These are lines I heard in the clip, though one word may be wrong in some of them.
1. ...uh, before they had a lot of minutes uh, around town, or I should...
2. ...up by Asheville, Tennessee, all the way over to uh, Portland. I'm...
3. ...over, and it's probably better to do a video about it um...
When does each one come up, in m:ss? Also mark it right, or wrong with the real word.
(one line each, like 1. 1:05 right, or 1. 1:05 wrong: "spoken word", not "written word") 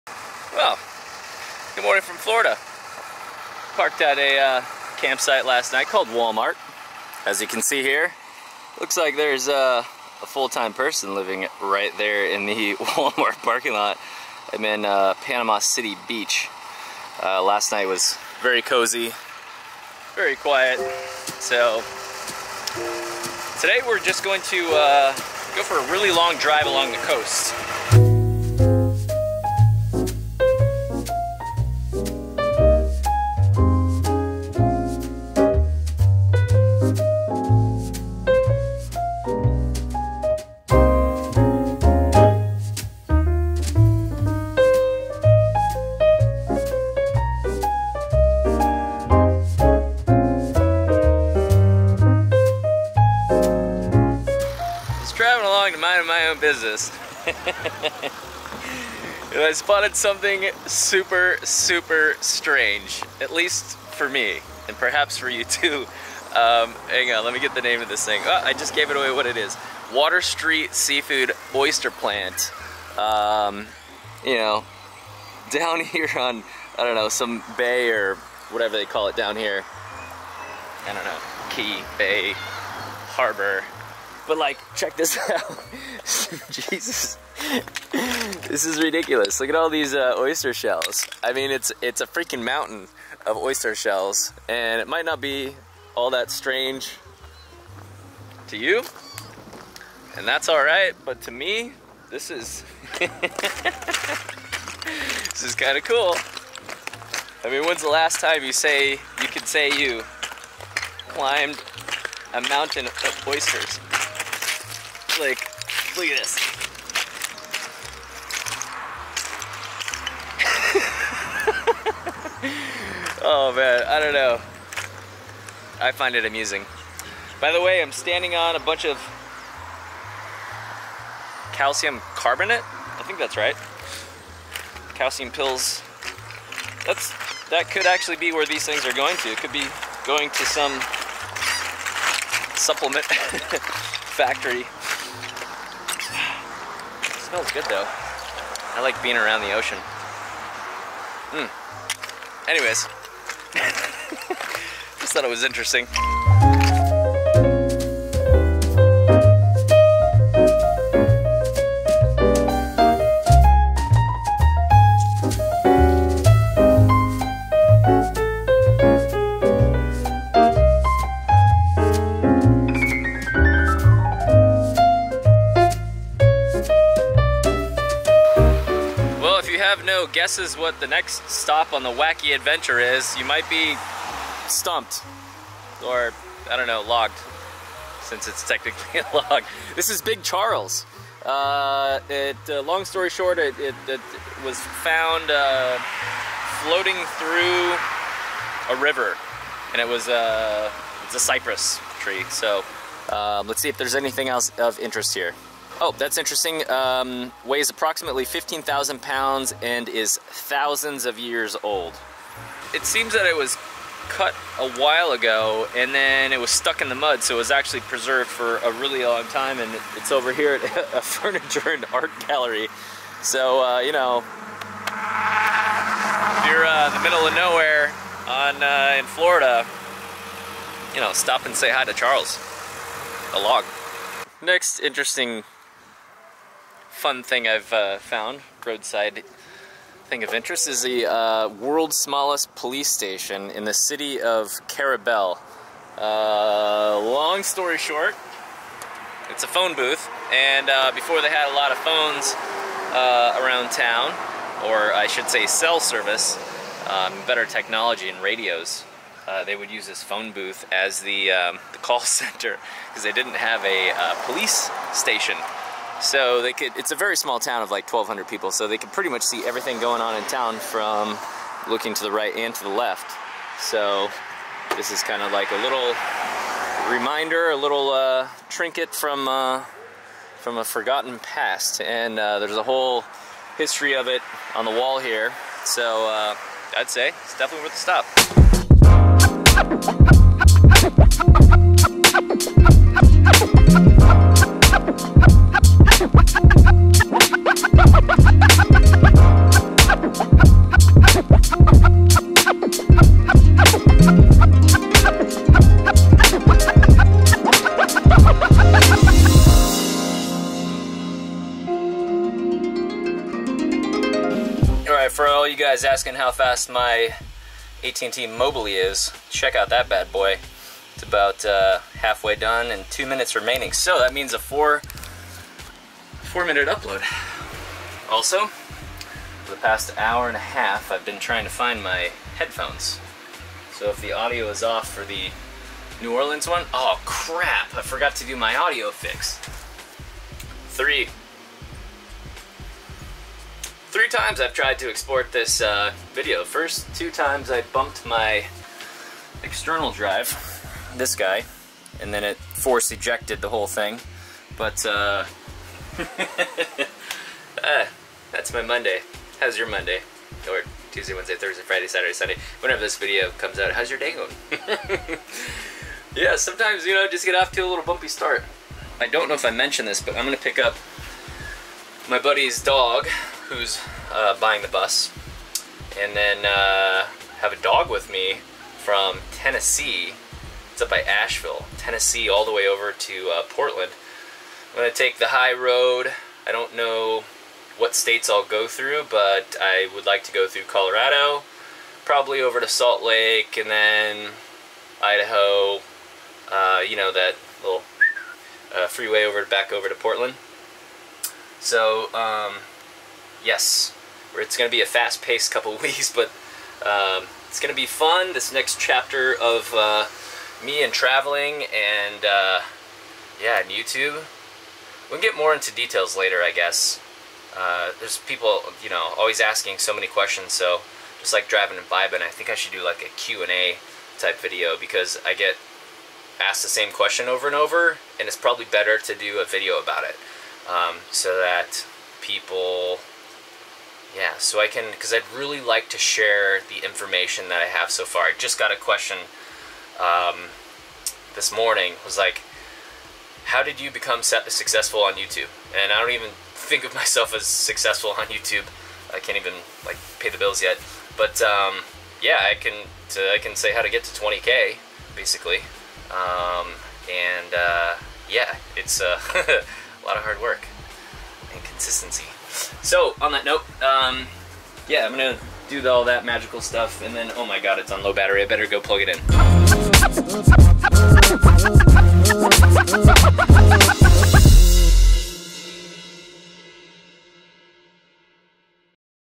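1. 4:10 wrong: "phones", not "minutes"
2. 6:20 right
3. 7:07 right.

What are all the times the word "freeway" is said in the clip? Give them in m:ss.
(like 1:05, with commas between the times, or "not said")
6:38.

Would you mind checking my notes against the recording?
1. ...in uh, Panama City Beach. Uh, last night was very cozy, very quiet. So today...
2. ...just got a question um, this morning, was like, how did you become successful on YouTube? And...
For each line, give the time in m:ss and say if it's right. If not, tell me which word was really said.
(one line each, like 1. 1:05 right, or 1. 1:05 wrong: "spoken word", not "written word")
1. 0:14 right
2. 7:18 right.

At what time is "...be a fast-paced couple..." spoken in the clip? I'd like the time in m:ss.
6:44.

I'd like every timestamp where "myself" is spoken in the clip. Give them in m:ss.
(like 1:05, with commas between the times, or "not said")
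7:26.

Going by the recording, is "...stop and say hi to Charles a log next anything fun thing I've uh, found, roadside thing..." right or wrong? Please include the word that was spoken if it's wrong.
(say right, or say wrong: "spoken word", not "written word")
wrong: "interesting", not "anything".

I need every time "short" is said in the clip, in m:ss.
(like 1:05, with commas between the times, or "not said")
3:13, 4:07.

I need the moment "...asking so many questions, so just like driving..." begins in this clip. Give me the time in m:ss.
6:59.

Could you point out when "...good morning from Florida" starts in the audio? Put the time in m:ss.
0:01.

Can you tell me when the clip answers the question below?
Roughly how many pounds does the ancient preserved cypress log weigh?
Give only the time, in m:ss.
3:28.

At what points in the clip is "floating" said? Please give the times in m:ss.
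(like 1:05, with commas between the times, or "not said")
3:16.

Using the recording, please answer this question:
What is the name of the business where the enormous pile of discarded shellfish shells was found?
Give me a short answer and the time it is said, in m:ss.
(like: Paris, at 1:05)
Water Street Seafood Oyster Plant, at 1:09.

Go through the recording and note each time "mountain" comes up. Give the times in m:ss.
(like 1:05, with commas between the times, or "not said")
1:32, 1:52.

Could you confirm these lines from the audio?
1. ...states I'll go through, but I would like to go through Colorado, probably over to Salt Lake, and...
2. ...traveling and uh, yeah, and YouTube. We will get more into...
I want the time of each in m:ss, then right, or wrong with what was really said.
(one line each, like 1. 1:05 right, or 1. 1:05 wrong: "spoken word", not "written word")
1. 6:27 right
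2. 6:50 right.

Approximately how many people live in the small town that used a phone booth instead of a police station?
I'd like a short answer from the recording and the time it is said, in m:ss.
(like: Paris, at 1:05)
1,200, at 4:27.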